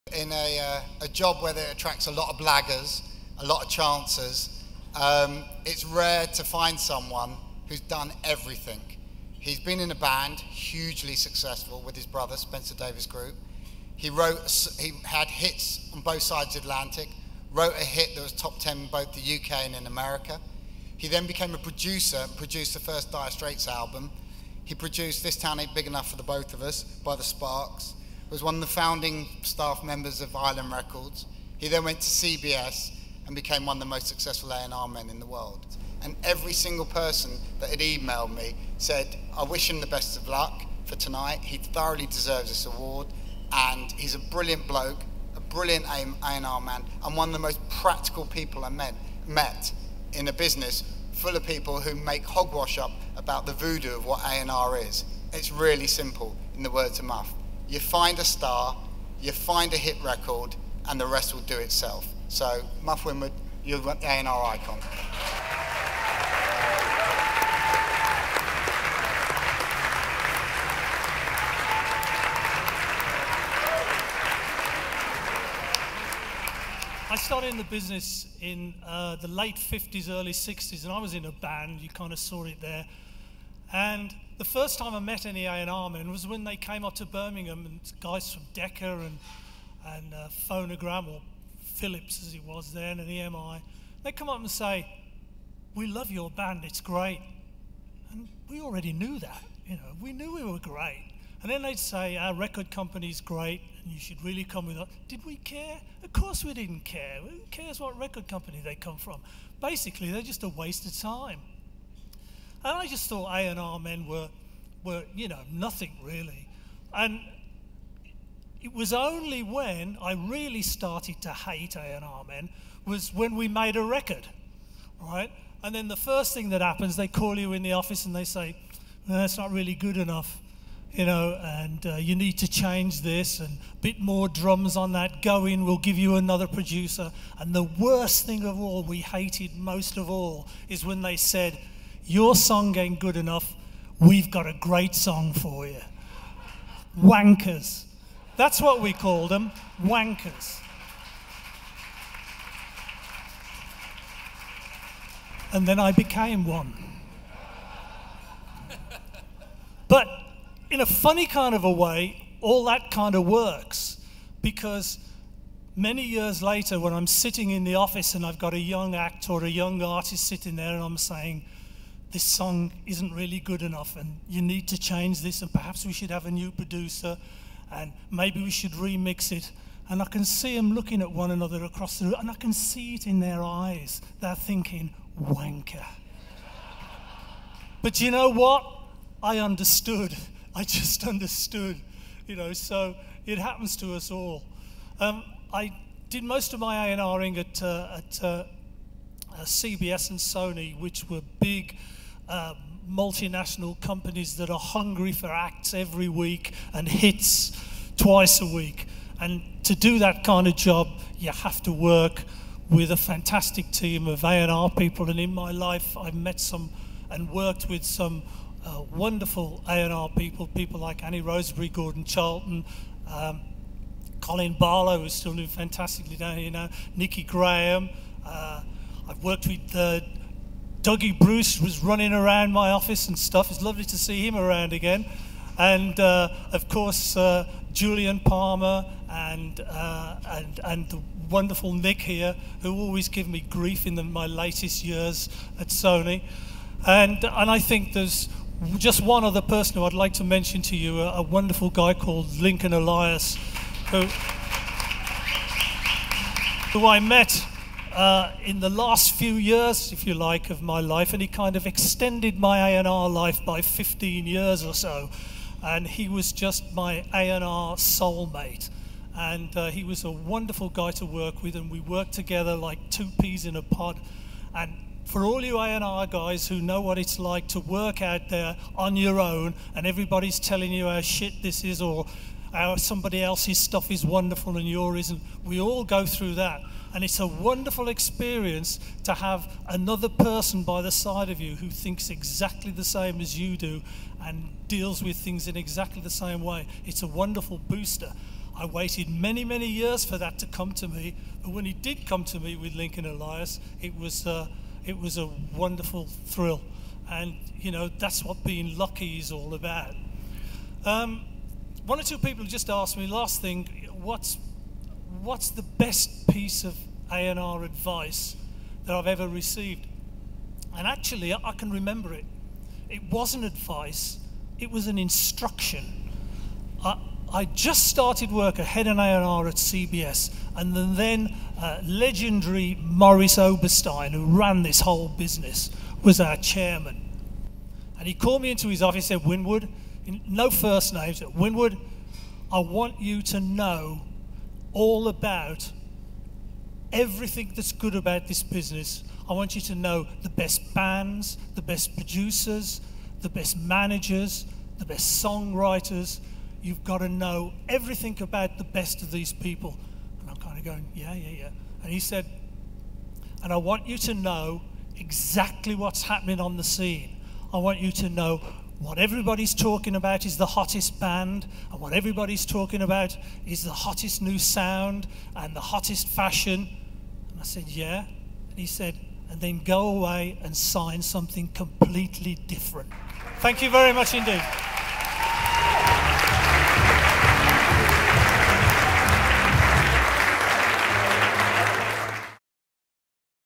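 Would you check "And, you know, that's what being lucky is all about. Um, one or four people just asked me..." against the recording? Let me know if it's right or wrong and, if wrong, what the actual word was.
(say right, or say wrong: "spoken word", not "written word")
wrong: "two", not "four".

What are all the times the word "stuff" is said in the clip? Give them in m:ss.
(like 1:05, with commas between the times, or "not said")
3:53, 4:43.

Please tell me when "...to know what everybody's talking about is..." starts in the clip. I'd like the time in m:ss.
6:07.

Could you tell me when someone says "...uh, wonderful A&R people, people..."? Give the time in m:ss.
3:38.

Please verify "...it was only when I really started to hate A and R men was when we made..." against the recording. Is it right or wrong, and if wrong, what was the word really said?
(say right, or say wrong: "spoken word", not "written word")
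right.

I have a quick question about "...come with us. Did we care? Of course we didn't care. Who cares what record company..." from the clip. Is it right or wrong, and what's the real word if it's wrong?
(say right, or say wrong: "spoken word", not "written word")
right.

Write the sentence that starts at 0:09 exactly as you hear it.
He's been in a band, hugely successful with his brother, Spencer Davis Group.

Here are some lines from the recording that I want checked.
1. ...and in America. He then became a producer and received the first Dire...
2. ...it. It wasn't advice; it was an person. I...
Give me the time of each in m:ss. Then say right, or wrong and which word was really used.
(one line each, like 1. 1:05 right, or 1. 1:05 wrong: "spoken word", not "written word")
1. 0:19 wrong: "produced", not "received"
2. 5:22 wrong: "instruction", not "person".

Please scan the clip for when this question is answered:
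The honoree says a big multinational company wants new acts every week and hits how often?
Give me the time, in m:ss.
3:27.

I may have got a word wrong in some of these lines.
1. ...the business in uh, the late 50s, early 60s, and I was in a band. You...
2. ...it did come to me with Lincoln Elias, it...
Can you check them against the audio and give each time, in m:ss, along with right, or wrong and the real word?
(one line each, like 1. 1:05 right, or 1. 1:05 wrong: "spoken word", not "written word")
1. 1:17 right
2. 5:01 right.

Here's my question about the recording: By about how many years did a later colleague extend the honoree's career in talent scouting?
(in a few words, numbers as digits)
15.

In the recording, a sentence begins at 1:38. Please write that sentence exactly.
And we already knew that, you know, we knew we were great.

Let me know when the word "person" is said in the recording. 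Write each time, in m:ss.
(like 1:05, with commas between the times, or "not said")
0:36, 4:09, 4:50.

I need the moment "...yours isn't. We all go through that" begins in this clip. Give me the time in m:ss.
4:44.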